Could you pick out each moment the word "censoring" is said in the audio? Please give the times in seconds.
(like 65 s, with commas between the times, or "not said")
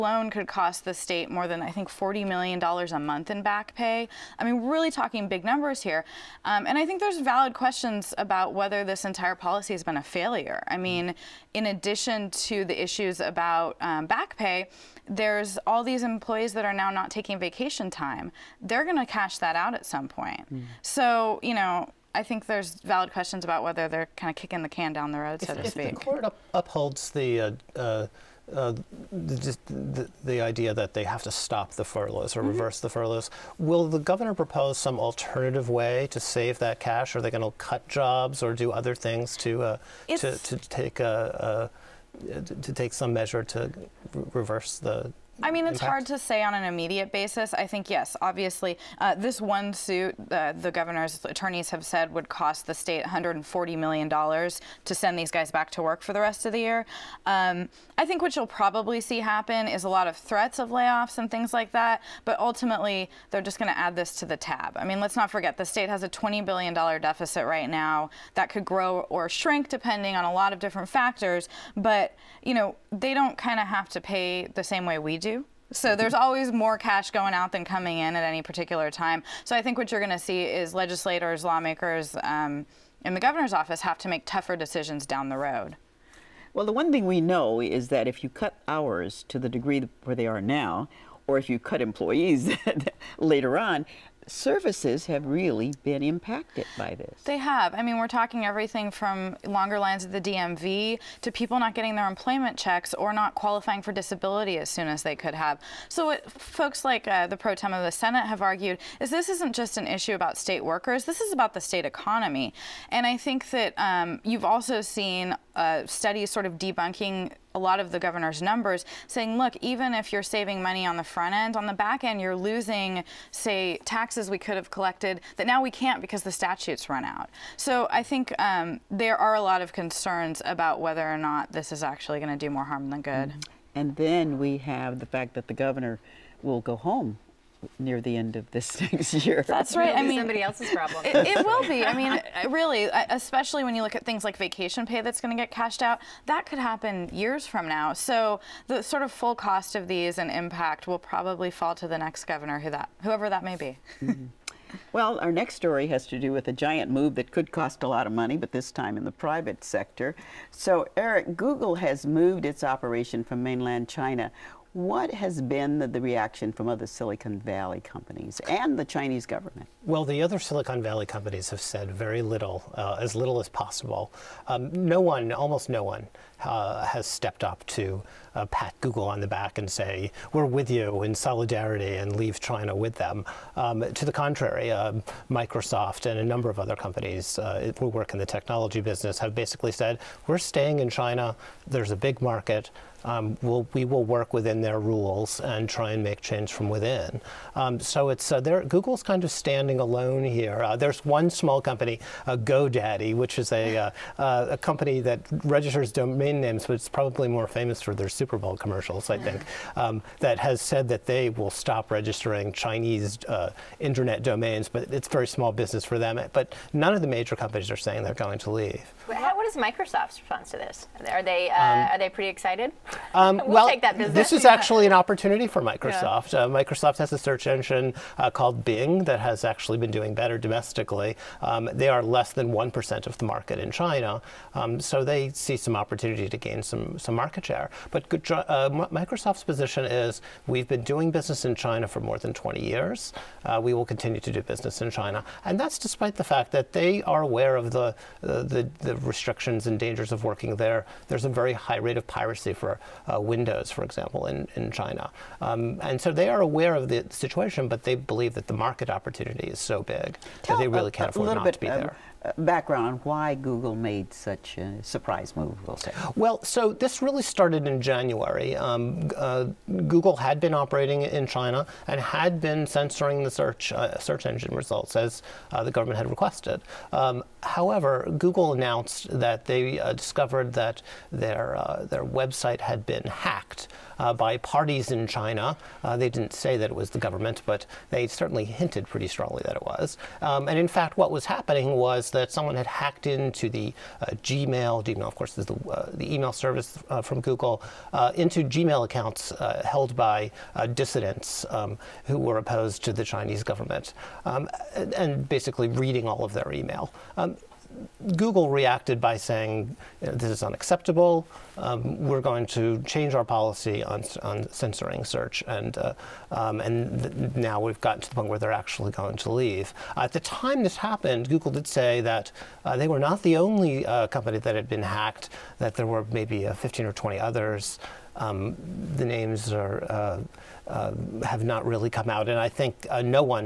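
272 s, 314 s.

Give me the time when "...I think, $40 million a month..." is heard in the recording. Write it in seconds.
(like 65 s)
1 s.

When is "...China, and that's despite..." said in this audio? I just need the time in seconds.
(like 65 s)
244 s.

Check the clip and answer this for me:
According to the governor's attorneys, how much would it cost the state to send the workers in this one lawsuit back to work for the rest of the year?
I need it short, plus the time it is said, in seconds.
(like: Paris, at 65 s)
$140 million, at 53 s.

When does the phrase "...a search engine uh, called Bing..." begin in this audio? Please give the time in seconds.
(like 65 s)
227 s.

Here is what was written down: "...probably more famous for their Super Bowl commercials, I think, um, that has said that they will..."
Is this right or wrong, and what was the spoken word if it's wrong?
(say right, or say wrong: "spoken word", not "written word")
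right.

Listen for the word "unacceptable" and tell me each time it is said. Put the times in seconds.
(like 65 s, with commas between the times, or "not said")
310 s.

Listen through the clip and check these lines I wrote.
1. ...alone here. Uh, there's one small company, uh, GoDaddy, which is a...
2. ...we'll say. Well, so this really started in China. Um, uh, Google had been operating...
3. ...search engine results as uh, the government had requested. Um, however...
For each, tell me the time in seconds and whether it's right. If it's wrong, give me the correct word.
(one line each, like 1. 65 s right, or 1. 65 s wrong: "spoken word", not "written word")
1. 199 s right
2. 265 s wrong: "January", not "China"
3. 273 s right.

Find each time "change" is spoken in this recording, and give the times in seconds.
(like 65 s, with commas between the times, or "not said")
196 s, 312 s.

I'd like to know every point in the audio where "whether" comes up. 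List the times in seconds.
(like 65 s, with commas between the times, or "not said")
8 s, 23 s, 130 s.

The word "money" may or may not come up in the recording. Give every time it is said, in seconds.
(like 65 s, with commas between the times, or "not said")
120 s, 158 s.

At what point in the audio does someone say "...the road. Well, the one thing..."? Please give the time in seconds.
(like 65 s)
85 s.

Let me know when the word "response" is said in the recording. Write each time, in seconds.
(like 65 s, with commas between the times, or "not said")
220 s.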